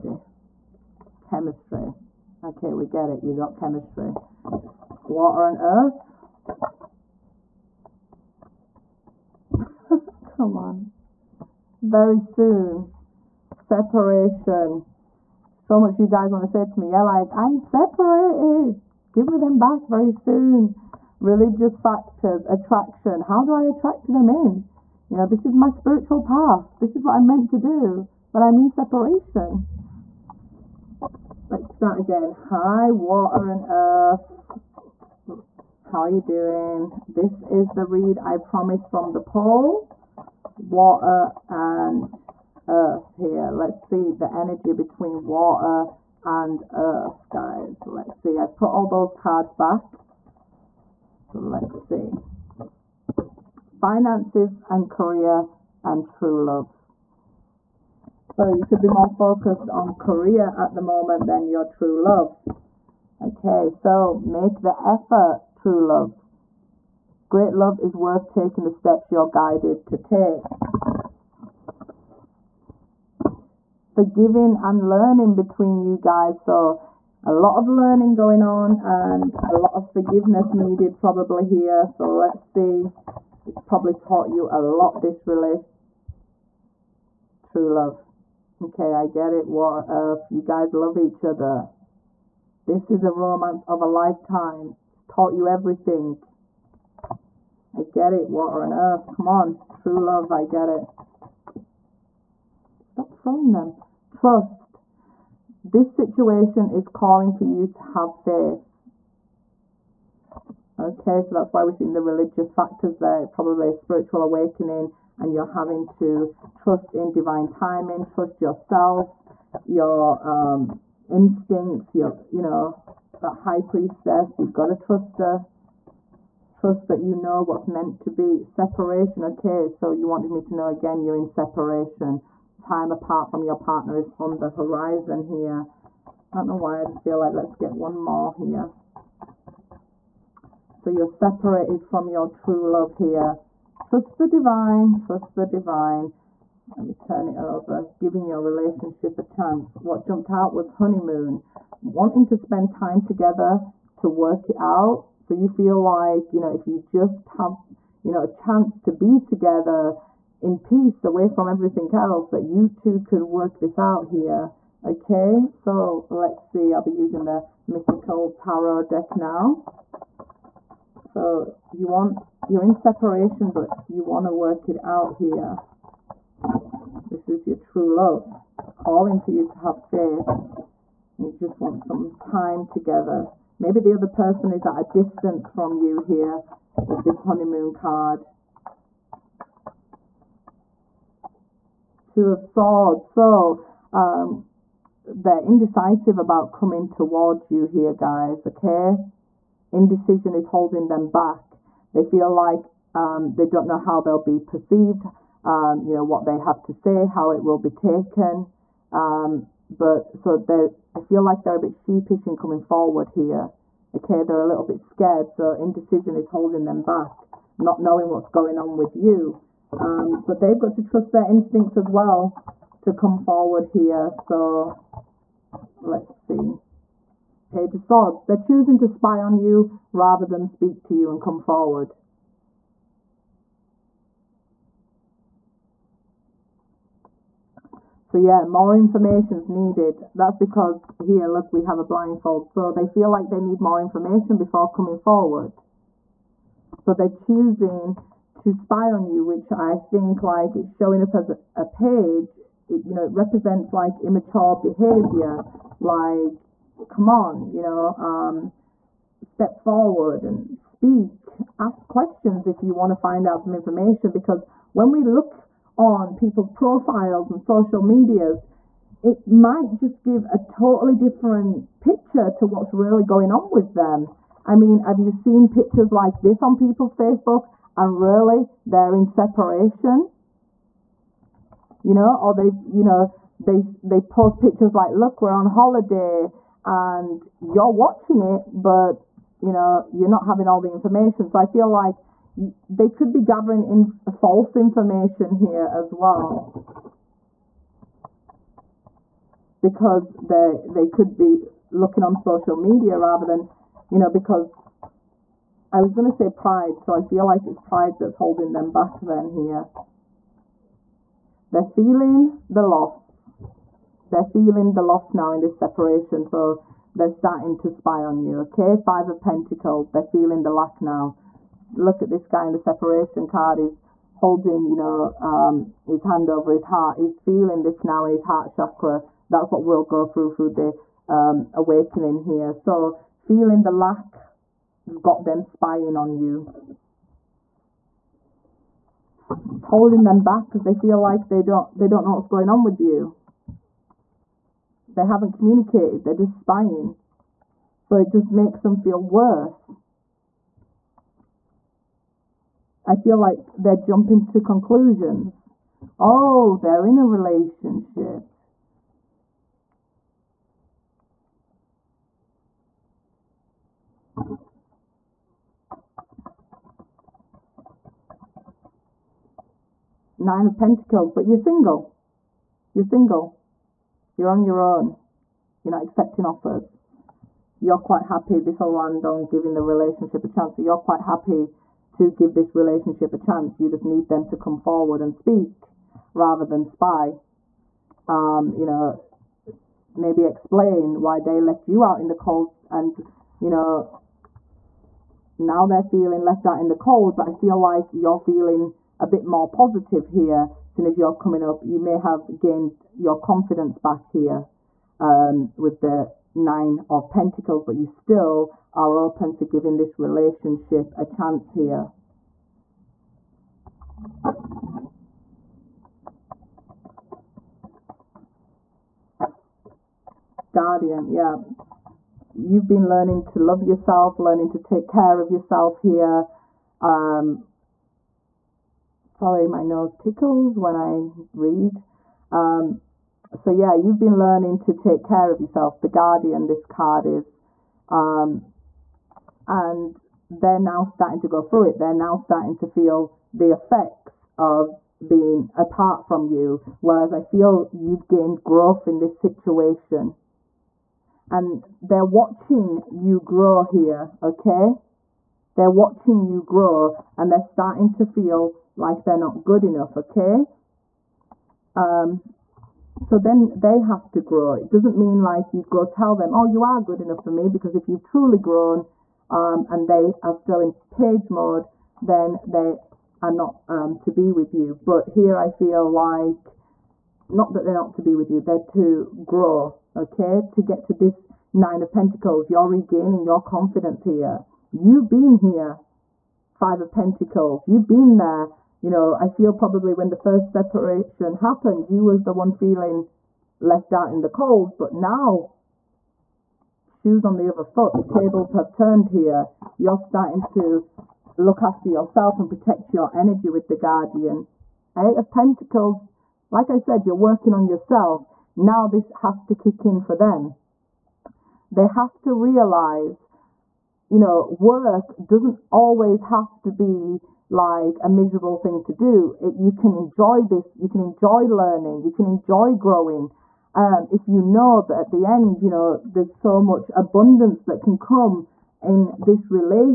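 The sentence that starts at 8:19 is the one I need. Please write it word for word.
You're starting to look after yourself and protect your energy with the guardian.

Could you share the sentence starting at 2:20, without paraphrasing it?
So you're separated from your true love here.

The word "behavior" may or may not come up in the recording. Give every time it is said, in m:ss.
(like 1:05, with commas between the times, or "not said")
4:14.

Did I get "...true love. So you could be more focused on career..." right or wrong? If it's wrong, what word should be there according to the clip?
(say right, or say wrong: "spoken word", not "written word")
right.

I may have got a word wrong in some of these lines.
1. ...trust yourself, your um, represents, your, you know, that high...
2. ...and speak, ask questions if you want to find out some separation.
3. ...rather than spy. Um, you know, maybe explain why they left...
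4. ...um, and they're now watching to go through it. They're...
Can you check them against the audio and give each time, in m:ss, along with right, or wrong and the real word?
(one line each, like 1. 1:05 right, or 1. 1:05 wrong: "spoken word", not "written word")
1. 1:58 wrong: "instincts", not "represents"
2. 4:20 wrong: "information", not "separation"
3. 6:26 right
4. 7:17 wrong: "starting", not "watching".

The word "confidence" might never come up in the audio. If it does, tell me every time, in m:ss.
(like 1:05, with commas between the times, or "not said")
6:43, 8:03.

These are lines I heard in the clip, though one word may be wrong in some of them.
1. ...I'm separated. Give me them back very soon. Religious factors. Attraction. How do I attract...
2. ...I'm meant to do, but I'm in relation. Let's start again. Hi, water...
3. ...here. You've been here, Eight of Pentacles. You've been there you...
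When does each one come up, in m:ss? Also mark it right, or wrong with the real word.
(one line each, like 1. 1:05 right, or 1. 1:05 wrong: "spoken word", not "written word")
1. 0:17 right
2. 0:27 wrong: "separation", not "relation"
3. 8:04 wrong: "Five", not "Eight".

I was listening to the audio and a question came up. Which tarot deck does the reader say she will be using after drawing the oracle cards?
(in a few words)
Mythical tarot deck.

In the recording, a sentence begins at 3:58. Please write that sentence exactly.
So yeah, more information is needed.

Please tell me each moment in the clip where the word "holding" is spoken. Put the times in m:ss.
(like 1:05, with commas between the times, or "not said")
3:20, 3:36, 5:08, 5:24, 5:39.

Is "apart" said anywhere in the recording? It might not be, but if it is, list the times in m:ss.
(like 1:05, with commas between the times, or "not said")
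2:12, 7:25.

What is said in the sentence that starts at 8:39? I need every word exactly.
It, you can enjoy this, you can enjoy learning, you can enjoy growing.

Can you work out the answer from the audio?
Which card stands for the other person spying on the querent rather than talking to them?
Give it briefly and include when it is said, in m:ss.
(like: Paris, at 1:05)
Page of Swords, at 3:47.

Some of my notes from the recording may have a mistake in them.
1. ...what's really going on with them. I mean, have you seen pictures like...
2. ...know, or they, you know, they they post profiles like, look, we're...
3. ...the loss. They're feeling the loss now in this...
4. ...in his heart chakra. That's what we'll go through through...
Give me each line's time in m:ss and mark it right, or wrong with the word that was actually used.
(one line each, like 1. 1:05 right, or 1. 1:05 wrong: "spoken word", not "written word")
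1. 4:32 right
2. 4:41 wrong: "pictures", not "profiles"
3. 5:12 right
4. 5:28 right.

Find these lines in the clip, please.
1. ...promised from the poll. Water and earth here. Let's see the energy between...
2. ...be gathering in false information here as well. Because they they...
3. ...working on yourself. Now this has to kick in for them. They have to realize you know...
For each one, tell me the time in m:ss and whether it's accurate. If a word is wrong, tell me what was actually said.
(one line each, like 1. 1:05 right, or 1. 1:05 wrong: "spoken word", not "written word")
1. 0:38 right
2. 4:53 right
3. 8:27 right.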